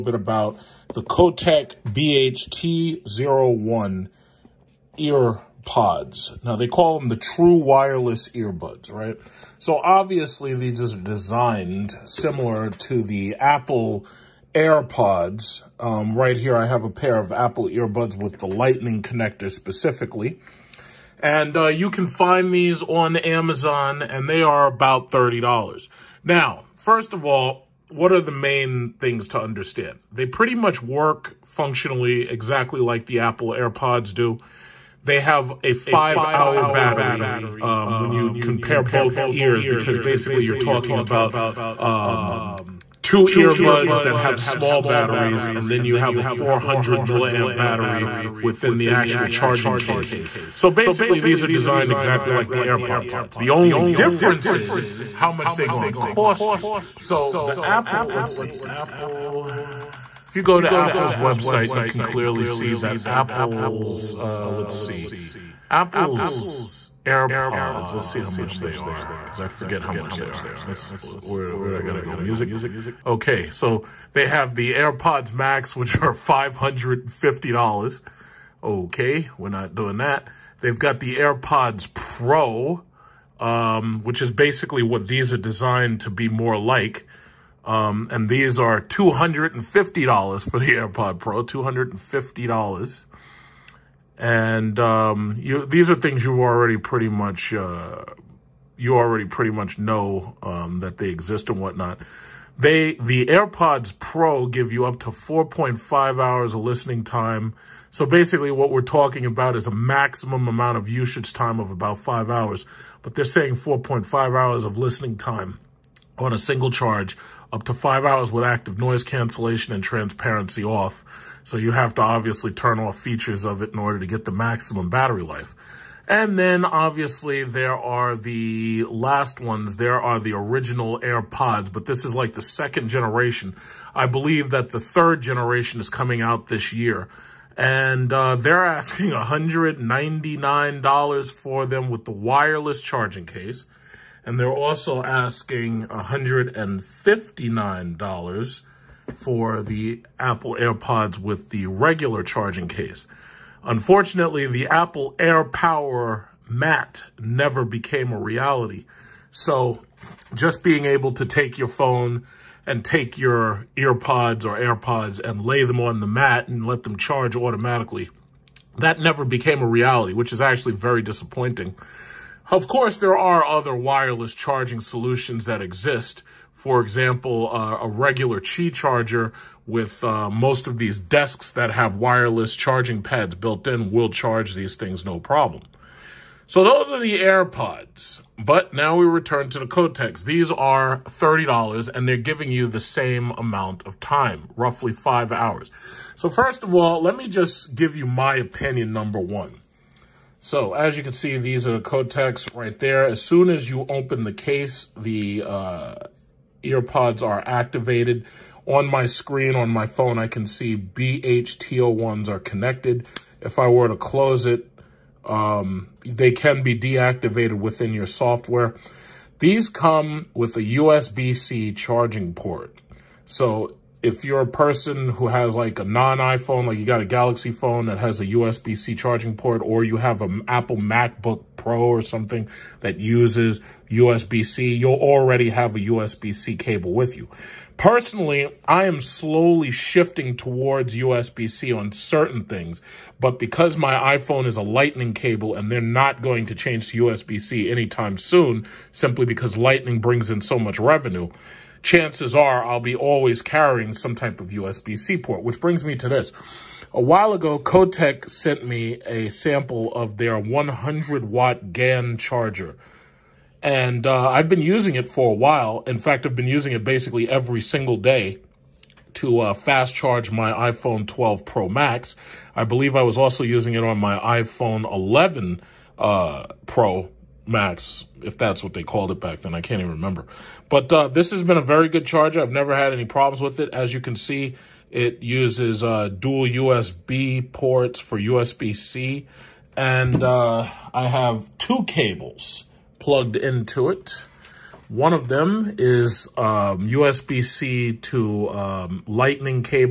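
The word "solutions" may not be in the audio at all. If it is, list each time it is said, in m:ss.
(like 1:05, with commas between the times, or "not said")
2:54.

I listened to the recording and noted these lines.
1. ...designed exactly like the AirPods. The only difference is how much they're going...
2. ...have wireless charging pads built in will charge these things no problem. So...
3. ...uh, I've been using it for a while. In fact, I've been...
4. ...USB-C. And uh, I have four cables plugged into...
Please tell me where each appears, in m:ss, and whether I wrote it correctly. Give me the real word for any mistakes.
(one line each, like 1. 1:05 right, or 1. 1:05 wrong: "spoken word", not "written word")
1. 0:51 right
2. 3:01 right
3. 4:24 right
4. 4:48 wrong: "two", not "four".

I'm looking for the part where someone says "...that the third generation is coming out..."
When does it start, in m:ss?
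2:14.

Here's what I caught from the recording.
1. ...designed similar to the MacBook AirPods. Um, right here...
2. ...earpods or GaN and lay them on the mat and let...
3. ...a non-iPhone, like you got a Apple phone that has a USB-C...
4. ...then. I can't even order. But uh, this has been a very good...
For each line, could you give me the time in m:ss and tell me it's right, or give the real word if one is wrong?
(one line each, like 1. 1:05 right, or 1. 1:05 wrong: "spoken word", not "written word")
1. 0:10 wrong: "Apple", not "MacBook"
2. 2:43 wrong: "AirPods", not "GaN"
3. 3:45 wrong: "Galaxy", not "Apple"
4. 4:39 wrong: "remember", not "order".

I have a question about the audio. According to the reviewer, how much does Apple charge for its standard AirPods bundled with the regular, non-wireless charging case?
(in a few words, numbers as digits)
$159.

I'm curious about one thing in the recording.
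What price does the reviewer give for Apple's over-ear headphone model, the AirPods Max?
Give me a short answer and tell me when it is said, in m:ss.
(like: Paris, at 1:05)
$550, at 1:16.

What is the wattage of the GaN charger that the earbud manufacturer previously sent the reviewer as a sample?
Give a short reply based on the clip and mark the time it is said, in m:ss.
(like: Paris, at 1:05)
100 watt, at 4:20.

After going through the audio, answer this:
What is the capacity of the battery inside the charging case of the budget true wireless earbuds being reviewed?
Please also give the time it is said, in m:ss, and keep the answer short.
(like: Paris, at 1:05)
400 milliamp, at 0:46.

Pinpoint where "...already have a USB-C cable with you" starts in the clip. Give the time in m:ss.
3:54.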